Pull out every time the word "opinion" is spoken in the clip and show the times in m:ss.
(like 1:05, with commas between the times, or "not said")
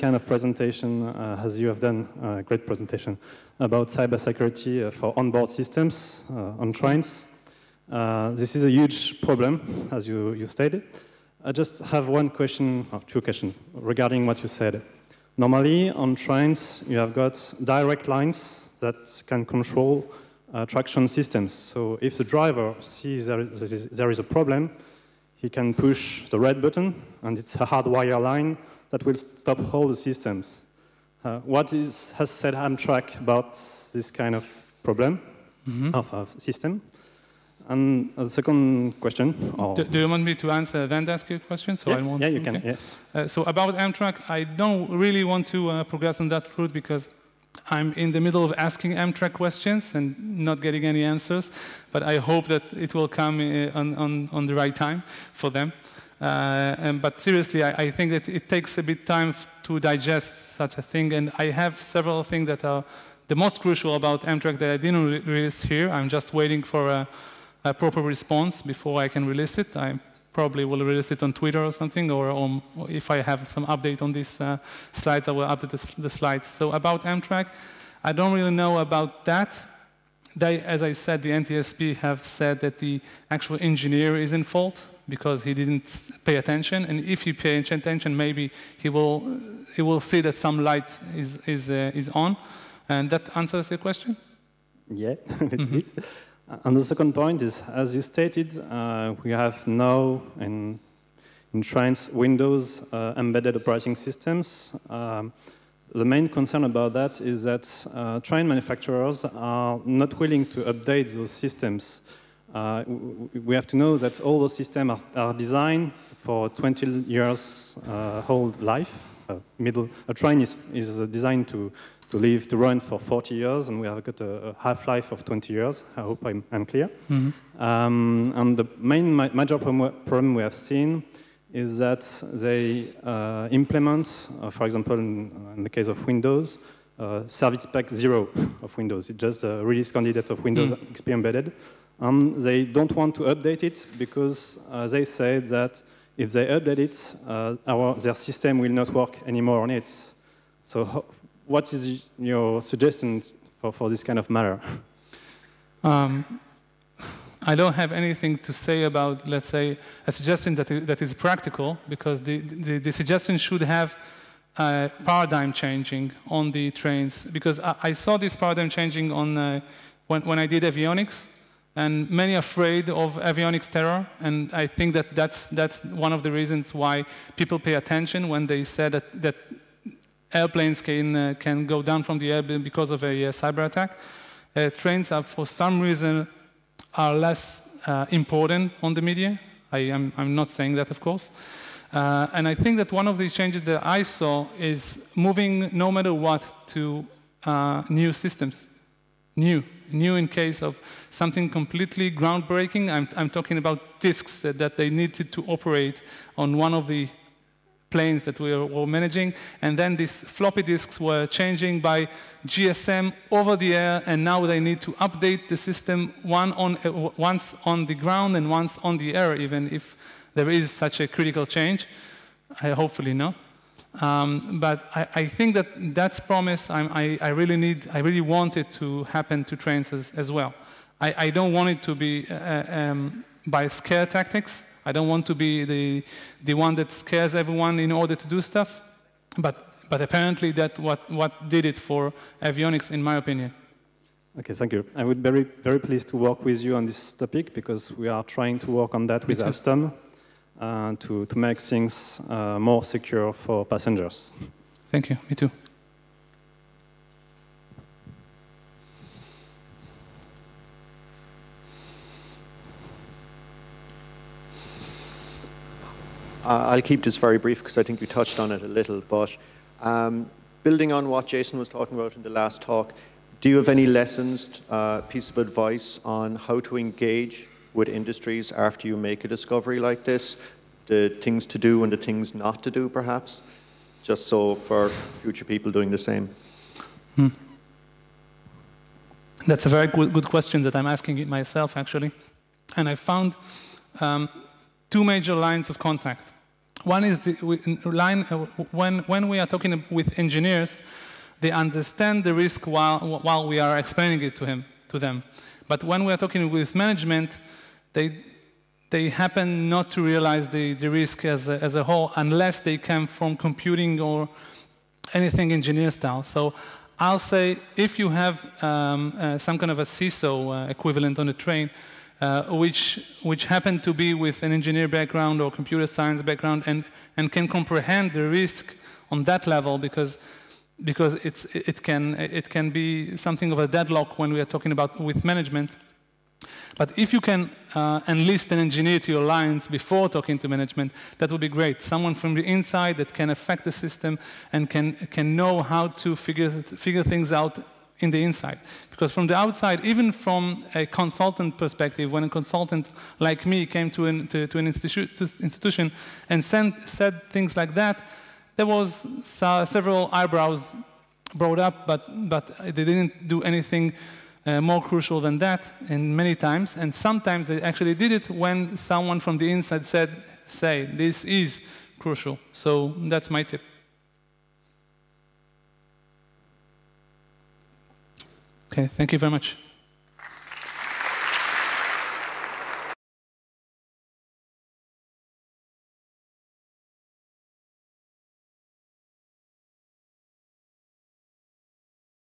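4:03.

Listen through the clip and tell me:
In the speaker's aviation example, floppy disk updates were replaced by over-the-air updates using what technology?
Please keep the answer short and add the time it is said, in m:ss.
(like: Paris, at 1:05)
GSM, at 3:32.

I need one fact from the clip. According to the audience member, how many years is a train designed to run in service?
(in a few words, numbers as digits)
40 years.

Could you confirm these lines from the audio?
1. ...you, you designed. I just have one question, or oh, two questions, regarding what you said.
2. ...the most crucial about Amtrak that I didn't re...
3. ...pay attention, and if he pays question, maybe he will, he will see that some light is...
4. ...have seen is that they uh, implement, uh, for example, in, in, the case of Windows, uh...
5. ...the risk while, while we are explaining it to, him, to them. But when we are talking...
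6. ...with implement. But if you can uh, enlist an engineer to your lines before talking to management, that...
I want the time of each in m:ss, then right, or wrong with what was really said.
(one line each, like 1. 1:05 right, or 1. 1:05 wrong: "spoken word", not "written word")
1. 0:10 wrong: "stated", not "designed"
2. 1:03 right
3. 1:26 wrong: "attention", not "question"
4. 2:10 right
5. 5:02 right
6. 5:35 wrong: "management", not "implement".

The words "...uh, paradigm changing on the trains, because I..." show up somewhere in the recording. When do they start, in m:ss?
2:44.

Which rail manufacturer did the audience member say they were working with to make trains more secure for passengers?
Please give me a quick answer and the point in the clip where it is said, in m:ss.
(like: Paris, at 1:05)
Alstom, at 4:09.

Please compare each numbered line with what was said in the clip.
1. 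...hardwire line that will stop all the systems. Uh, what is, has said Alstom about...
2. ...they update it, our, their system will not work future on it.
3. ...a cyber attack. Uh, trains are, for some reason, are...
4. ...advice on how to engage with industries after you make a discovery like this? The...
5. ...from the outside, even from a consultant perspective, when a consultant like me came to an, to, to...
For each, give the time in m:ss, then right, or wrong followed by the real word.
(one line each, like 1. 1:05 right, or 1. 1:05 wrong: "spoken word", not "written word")
1. 0:27 wrong: "Amtrak", not "Alstom"
2. 2:26 wrong: "anymore", not "future"
3. 3:03 right
4. 4:35 right
5. 5:49 right.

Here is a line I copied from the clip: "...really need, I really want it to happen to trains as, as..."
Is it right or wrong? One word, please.
right.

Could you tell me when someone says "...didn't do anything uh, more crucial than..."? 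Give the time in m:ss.
6:02.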